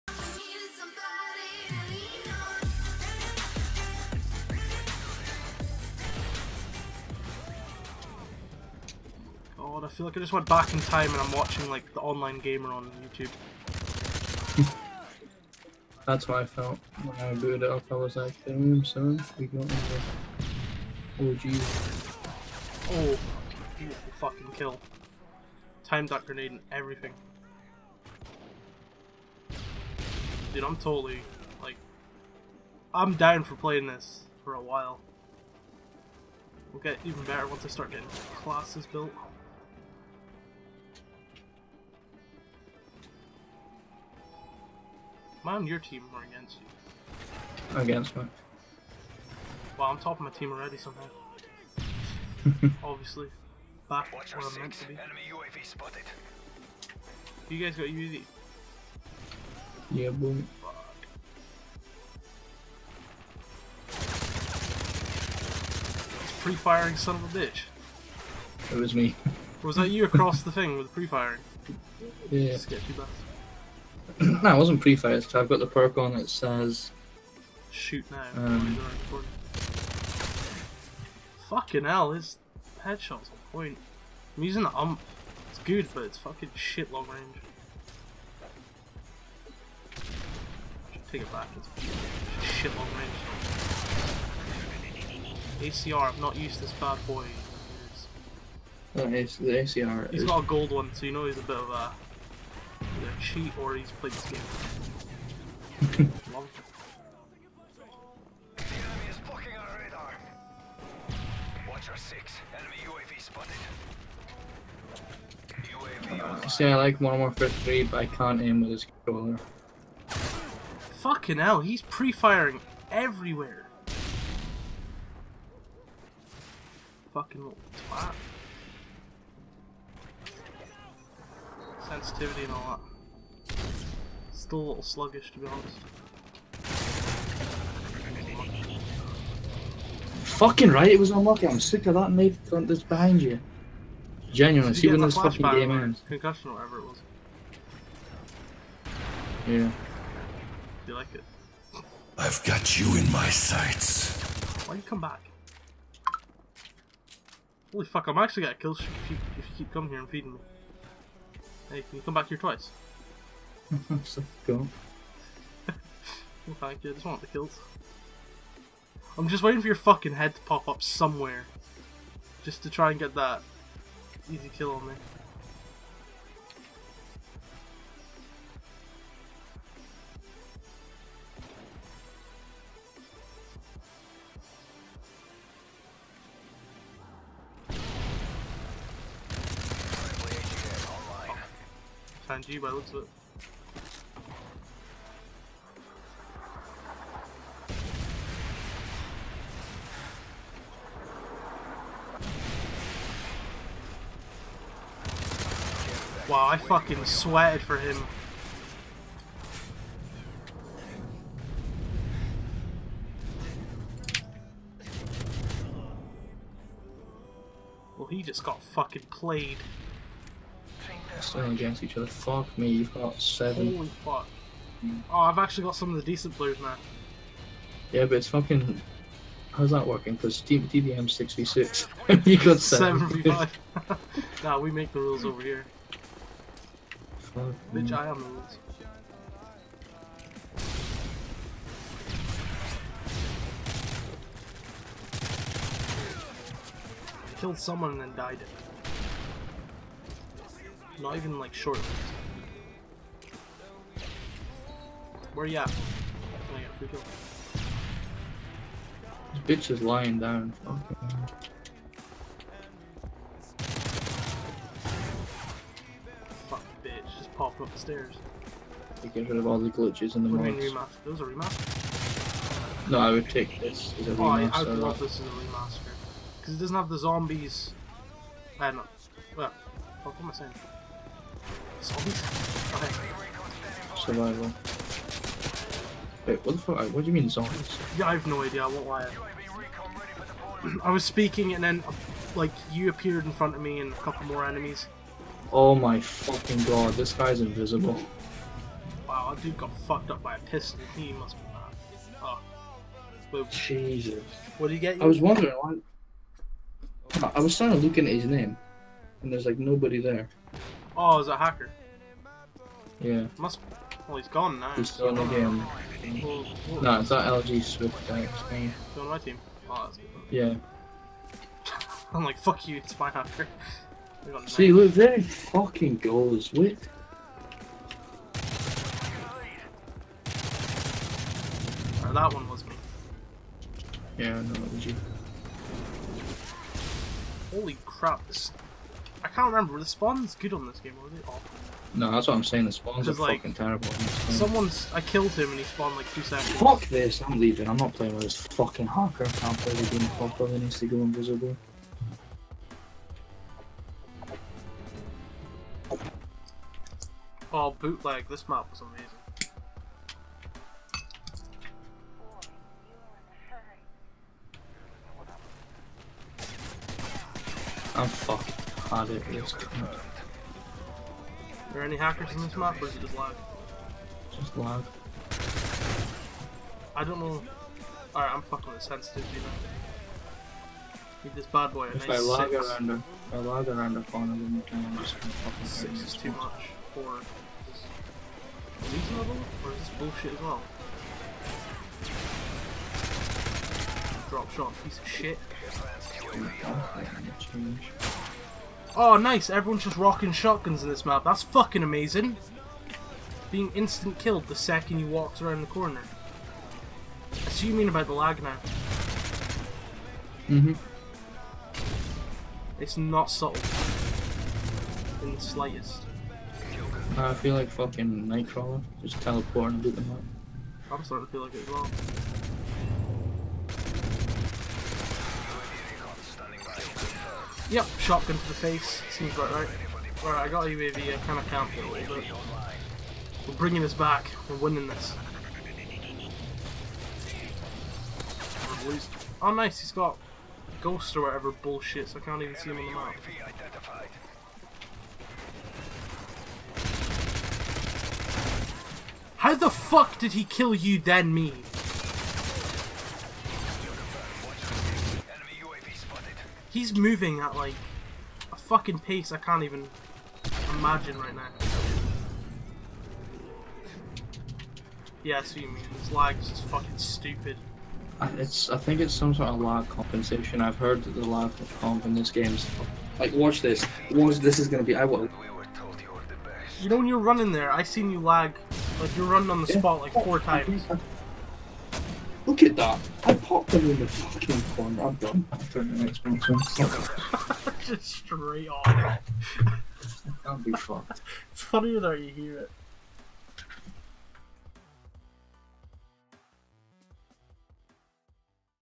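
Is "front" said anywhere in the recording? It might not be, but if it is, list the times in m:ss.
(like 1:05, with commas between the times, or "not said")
2:22, 4:53.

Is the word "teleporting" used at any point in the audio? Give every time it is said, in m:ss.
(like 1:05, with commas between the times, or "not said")
6:59.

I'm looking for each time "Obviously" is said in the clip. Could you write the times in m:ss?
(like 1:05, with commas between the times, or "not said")
0:52.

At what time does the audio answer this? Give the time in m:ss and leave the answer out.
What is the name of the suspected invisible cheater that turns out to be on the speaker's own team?
5:17.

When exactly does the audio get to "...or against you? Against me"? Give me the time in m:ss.
0:46.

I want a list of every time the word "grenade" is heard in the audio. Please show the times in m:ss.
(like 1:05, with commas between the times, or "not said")
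0:26.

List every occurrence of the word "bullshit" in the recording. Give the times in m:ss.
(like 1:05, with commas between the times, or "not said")
6:29, 7:21.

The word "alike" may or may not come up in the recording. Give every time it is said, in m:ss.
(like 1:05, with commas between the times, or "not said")
not said.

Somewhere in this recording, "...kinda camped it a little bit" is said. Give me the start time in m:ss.
7:11.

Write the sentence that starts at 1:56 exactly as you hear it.
see, I like one more for three, but I can't aim with this controller.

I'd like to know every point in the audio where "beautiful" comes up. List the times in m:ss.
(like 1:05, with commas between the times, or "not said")
0:23.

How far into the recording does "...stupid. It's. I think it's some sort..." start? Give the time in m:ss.
7:46.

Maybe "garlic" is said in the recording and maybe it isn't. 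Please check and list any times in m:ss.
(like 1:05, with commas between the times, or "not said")
not said.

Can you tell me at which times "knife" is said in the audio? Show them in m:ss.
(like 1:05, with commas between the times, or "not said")
2:22.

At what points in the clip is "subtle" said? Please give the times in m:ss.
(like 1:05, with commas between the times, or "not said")
6:53.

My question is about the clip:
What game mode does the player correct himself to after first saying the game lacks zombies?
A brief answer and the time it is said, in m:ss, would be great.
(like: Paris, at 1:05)
Survival, at 4:43.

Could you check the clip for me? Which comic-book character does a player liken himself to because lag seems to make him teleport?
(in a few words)
Nightcrawler.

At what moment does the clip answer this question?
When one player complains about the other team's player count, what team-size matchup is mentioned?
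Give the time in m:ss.
3:52.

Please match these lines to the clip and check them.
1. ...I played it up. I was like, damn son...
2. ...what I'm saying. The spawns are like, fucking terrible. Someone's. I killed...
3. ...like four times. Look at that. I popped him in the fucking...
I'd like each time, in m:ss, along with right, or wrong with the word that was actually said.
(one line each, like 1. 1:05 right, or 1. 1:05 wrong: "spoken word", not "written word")
1. 0:17 wrong: "booted", not "played"
2. 5:42 right
3. 8:00 right.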